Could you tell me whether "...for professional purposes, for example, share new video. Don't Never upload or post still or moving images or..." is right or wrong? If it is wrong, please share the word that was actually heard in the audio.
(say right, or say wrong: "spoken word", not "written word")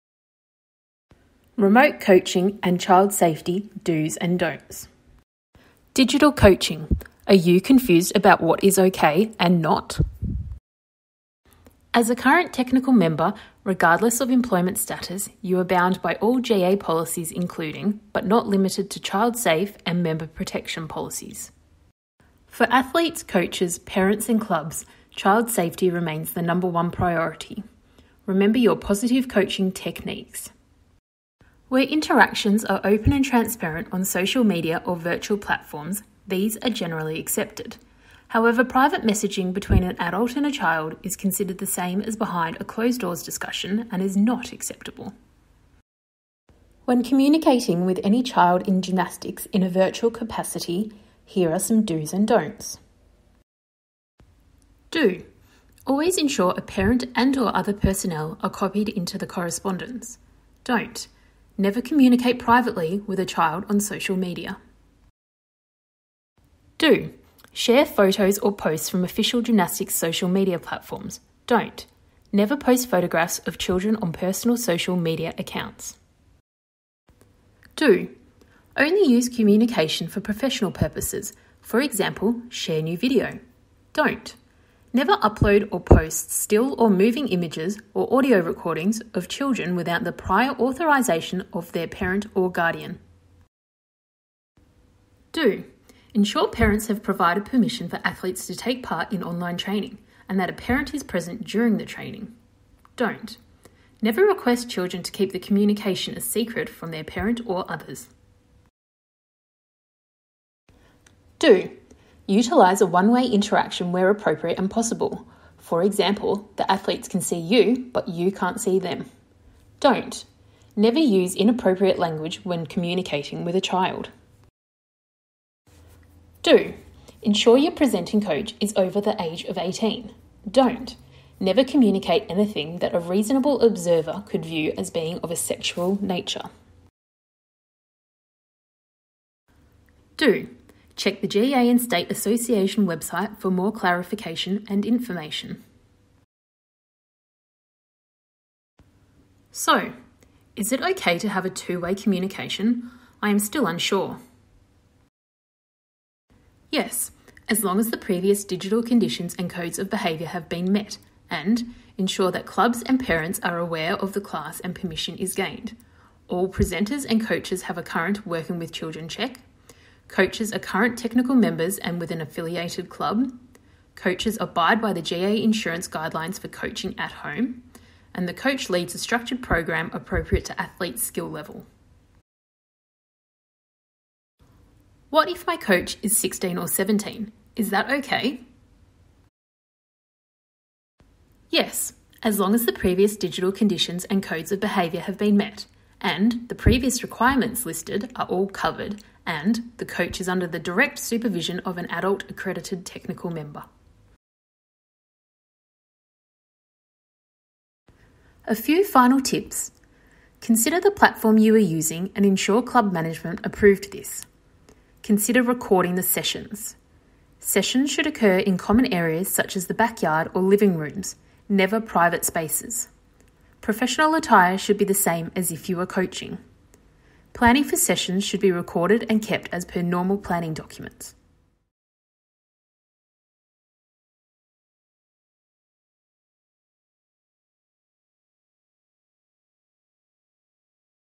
right.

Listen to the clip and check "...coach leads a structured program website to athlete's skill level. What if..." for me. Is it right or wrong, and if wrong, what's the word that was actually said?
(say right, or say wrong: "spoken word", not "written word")
wrong: "appropriate", not "website".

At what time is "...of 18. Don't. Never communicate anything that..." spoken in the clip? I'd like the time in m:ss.
2:09.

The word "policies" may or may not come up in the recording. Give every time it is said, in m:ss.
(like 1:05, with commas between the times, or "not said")
0:16, 0:20.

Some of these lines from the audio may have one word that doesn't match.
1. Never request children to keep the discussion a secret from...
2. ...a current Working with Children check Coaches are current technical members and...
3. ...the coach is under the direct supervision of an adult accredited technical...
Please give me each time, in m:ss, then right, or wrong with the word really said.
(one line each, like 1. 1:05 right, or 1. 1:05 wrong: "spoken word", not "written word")
1. 1:44 wrong: "communication", not "discussion"
2. 2:47 right
3. 3:19 right.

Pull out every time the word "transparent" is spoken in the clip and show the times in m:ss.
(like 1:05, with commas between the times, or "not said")
0:33.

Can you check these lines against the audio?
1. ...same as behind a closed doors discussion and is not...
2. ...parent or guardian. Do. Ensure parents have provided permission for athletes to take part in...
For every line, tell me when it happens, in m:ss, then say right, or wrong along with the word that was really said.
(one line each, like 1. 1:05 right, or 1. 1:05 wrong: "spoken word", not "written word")
1. 0:41 right
2. 1:31 right.